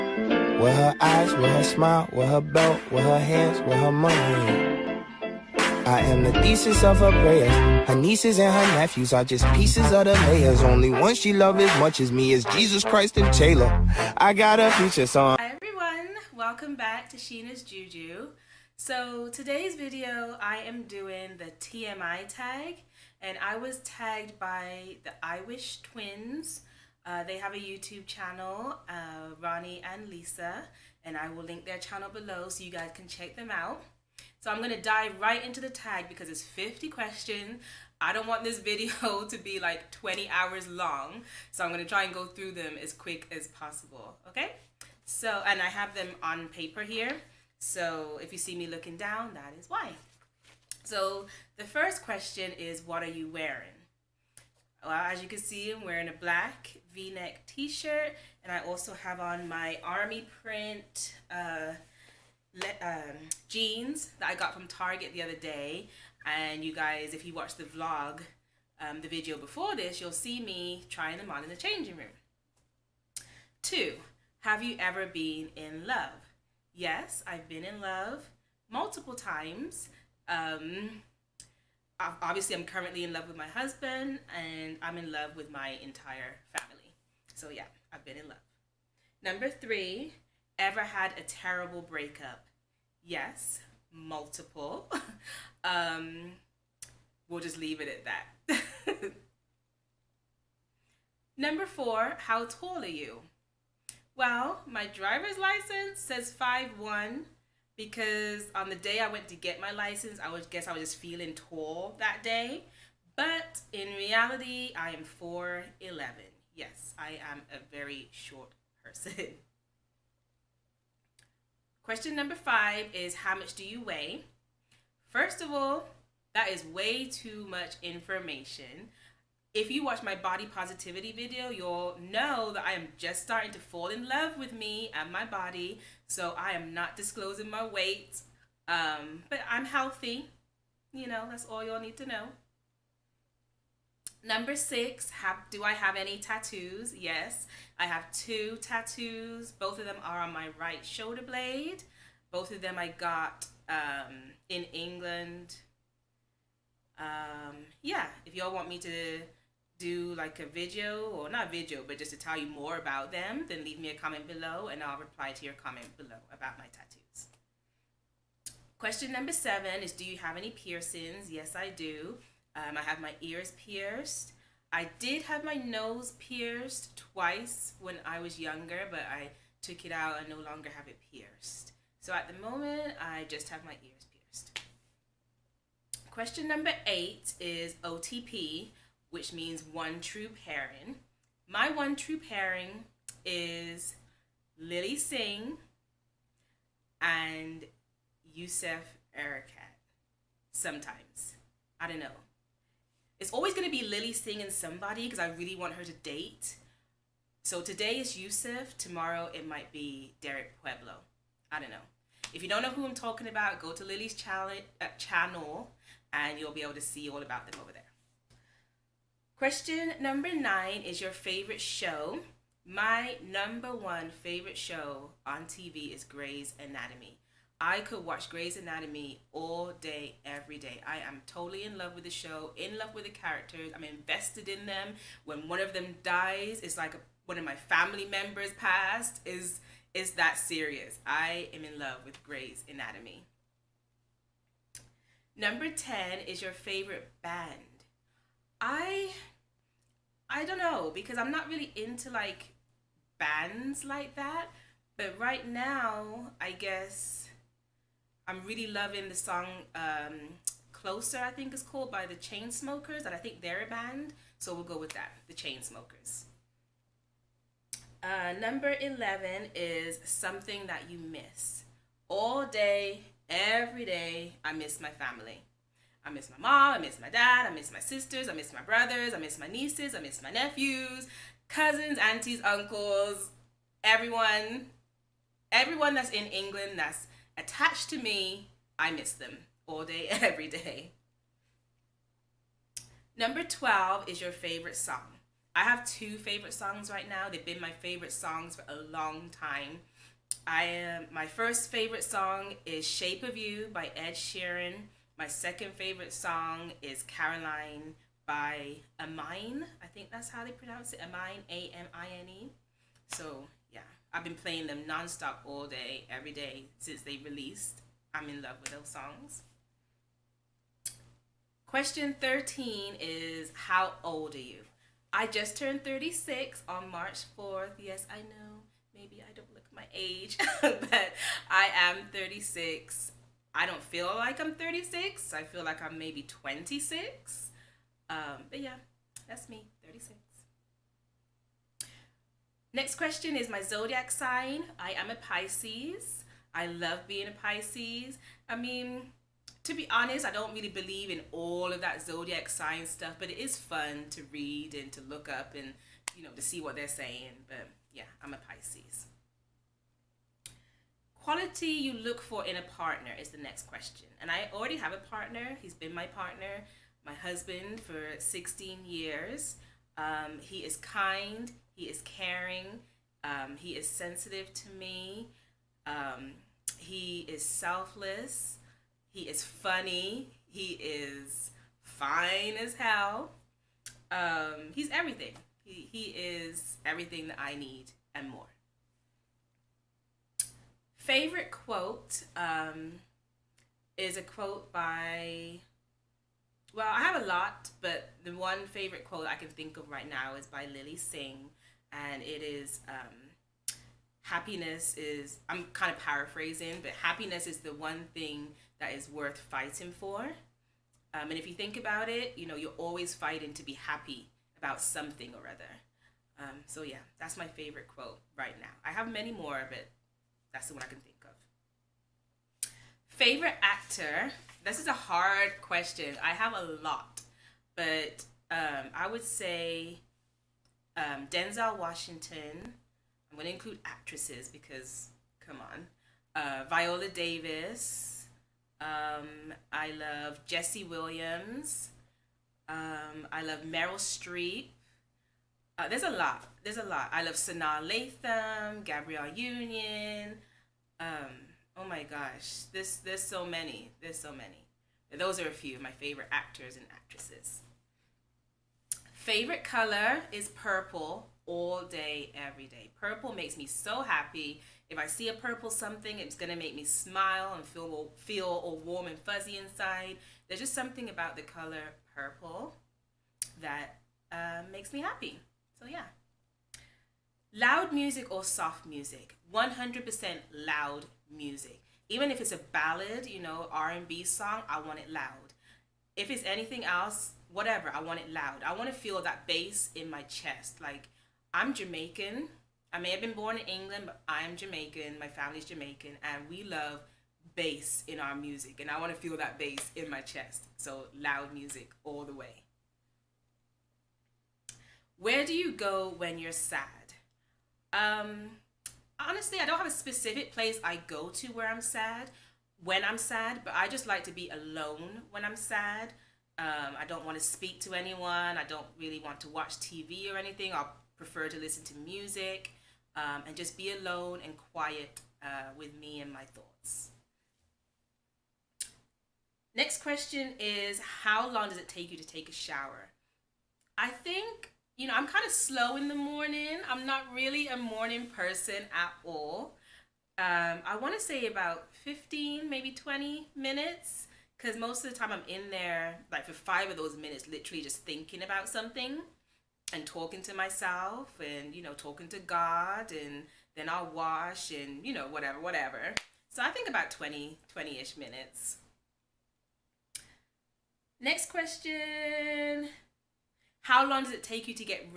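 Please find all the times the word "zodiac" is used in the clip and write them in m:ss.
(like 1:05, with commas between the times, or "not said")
5:43, 5:52.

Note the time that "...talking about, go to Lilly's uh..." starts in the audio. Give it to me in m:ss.
3:32.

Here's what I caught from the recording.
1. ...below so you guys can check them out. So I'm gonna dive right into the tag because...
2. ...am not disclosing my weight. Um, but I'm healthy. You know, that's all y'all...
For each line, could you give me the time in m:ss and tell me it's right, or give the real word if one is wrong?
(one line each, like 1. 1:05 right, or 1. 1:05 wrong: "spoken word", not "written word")
1. 0:32 right
2. 2:16 right.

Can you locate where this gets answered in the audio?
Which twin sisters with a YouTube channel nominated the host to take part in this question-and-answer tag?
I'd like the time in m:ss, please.
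0:25.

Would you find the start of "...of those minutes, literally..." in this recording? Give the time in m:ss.
9:06.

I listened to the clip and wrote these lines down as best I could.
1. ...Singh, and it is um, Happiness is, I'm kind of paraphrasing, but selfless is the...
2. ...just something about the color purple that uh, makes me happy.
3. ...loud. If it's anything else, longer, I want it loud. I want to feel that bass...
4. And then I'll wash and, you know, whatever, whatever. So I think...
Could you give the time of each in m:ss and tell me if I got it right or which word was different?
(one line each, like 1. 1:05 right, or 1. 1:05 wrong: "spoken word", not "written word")
1. 6:40 wrong: "happiness", not "selfless"
2. 7:50 right
3. 8:05 wrong: "whatever", not "longer"
4. 9:13 right.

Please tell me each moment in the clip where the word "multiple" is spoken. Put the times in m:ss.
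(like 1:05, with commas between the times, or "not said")
1:18, 1:33.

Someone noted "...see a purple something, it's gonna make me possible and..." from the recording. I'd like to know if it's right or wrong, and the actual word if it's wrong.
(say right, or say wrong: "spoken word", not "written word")
wrong: "smile", not "possible".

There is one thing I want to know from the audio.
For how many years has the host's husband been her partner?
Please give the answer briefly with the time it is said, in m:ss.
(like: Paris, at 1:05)
16 years, at 6:08.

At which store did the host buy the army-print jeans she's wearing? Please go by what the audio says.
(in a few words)
Target.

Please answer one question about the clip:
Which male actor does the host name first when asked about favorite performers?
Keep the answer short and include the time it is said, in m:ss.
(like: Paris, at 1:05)
Denzel Washington, at 7:11.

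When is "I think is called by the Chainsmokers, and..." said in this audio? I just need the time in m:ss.
4:21.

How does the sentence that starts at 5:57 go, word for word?
But yeah, I'm a Pisces quality you look for in a partner is the next question.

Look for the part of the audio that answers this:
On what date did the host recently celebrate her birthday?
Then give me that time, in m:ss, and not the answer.
5:26.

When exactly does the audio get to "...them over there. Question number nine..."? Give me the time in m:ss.
3:37.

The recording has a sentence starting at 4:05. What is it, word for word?
Number ten is your favorite band.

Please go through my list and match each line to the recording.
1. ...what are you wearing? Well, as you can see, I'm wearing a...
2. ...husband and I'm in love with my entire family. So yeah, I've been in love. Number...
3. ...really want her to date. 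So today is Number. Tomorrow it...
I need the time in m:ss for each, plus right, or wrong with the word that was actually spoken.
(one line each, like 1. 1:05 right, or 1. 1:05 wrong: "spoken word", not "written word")
1. 0:52 right
2. 1:23 right
3. 3:25 wrong: "Yusef", not "Number".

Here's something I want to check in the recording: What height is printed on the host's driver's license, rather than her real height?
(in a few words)
5'1.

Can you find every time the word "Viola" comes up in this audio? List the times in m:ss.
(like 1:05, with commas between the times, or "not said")
7:16.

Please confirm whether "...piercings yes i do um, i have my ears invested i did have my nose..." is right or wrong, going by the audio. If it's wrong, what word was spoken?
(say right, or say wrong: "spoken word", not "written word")
wrong: "pierced", not "invested".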